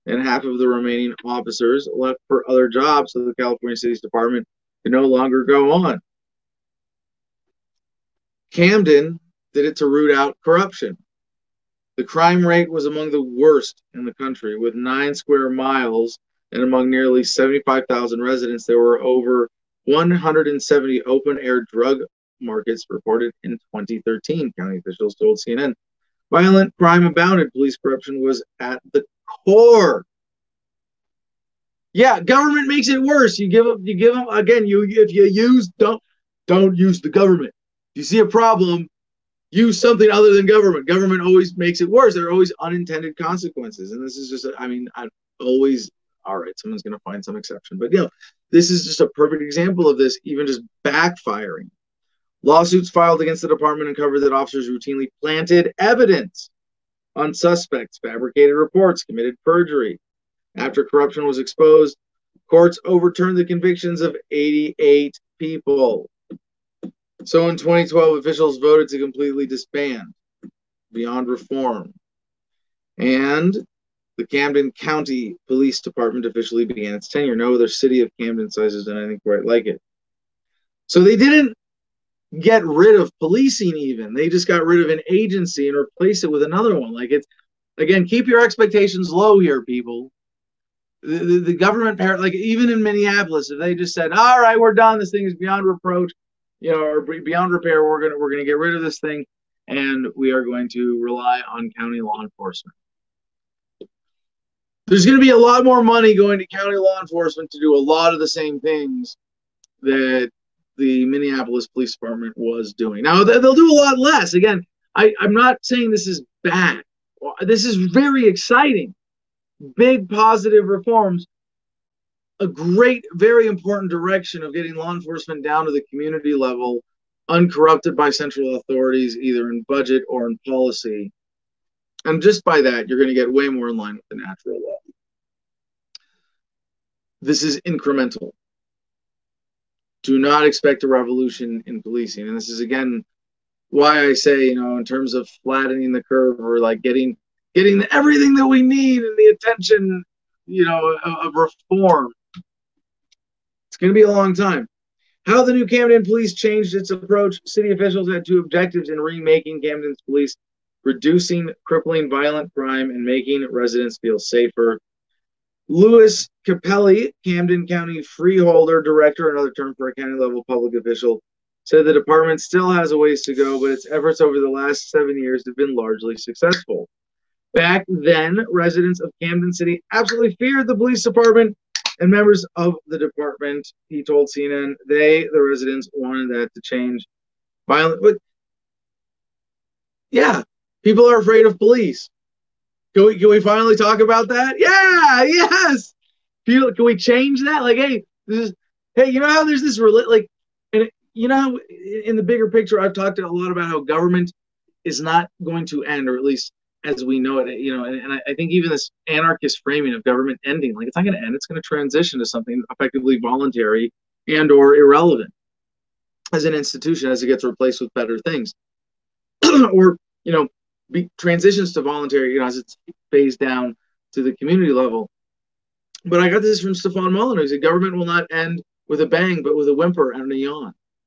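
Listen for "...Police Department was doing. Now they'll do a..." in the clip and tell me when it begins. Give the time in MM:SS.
01:51.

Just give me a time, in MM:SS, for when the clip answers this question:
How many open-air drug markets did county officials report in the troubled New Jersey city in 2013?
00:19.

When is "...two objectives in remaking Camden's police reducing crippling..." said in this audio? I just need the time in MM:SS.
02:38.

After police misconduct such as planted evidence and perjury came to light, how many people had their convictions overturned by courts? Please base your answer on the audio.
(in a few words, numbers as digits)
88.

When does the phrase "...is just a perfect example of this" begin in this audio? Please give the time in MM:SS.
00:48.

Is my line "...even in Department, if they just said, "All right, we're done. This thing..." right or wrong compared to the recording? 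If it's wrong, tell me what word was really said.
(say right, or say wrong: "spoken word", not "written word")
wrong: "Minneapolis", not "Department".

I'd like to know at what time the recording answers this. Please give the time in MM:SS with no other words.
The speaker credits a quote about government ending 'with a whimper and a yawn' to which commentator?
03:46.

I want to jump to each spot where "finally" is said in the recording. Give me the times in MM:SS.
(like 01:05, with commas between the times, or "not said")
03:13.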